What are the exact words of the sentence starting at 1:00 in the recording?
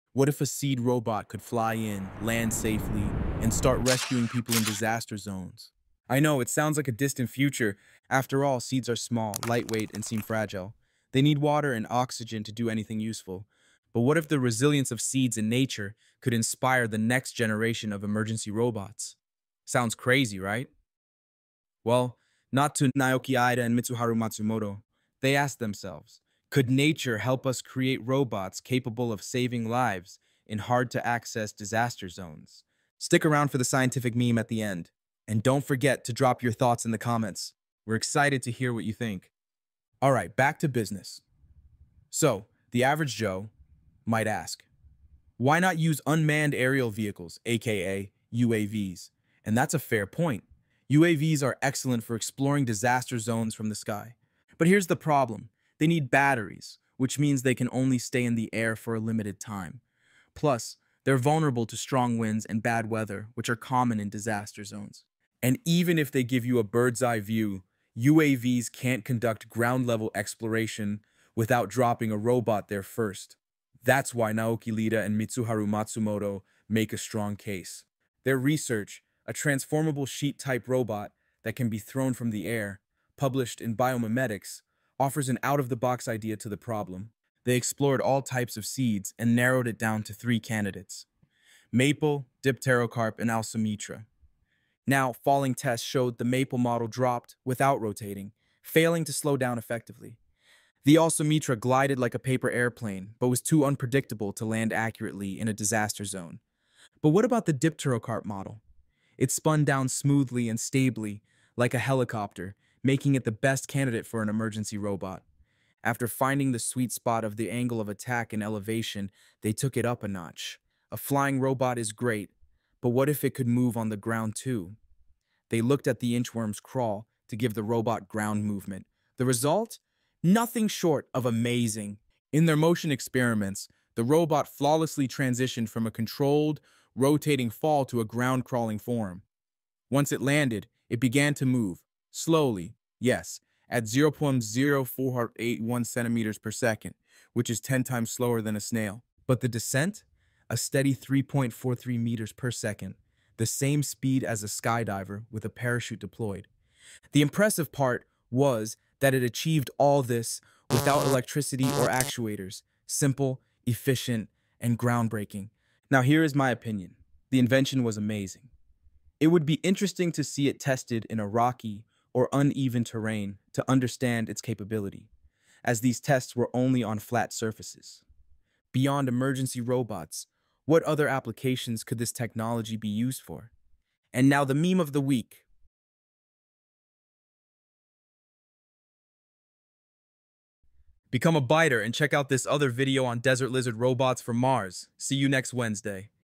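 Plus, they're vulnerable to strong winds and bad weather, which are common in disaster zones.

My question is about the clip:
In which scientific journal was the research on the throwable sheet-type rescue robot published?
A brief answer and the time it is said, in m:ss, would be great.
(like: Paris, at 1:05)
Biomimetics, at 1:23.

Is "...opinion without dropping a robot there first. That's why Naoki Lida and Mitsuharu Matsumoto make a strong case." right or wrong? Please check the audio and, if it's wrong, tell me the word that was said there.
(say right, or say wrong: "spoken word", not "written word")
wrong: "exploration", not "opinion".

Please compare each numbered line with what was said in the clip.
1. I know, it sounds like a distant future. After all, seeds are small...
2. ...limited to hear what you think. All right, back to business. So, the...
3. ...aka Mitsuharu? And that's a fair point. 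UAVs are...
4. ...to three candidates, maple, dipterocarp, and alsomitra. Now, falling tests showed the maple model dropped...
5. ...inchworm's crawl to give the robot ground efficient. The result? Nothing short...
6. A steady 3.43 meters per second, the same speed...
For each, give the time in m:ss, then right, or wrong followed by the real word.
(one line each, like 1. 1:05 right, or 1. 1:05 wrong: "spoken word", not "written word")
1. 0:06 right
2. 0:37 wrong: "excited", not "limited"
3. 0:47 wrong: "UAVs", not "Mitsuharu"
4. 1:30 right
5. 2:06 wrong: "movement", not "efficient"
6. 2:30 right.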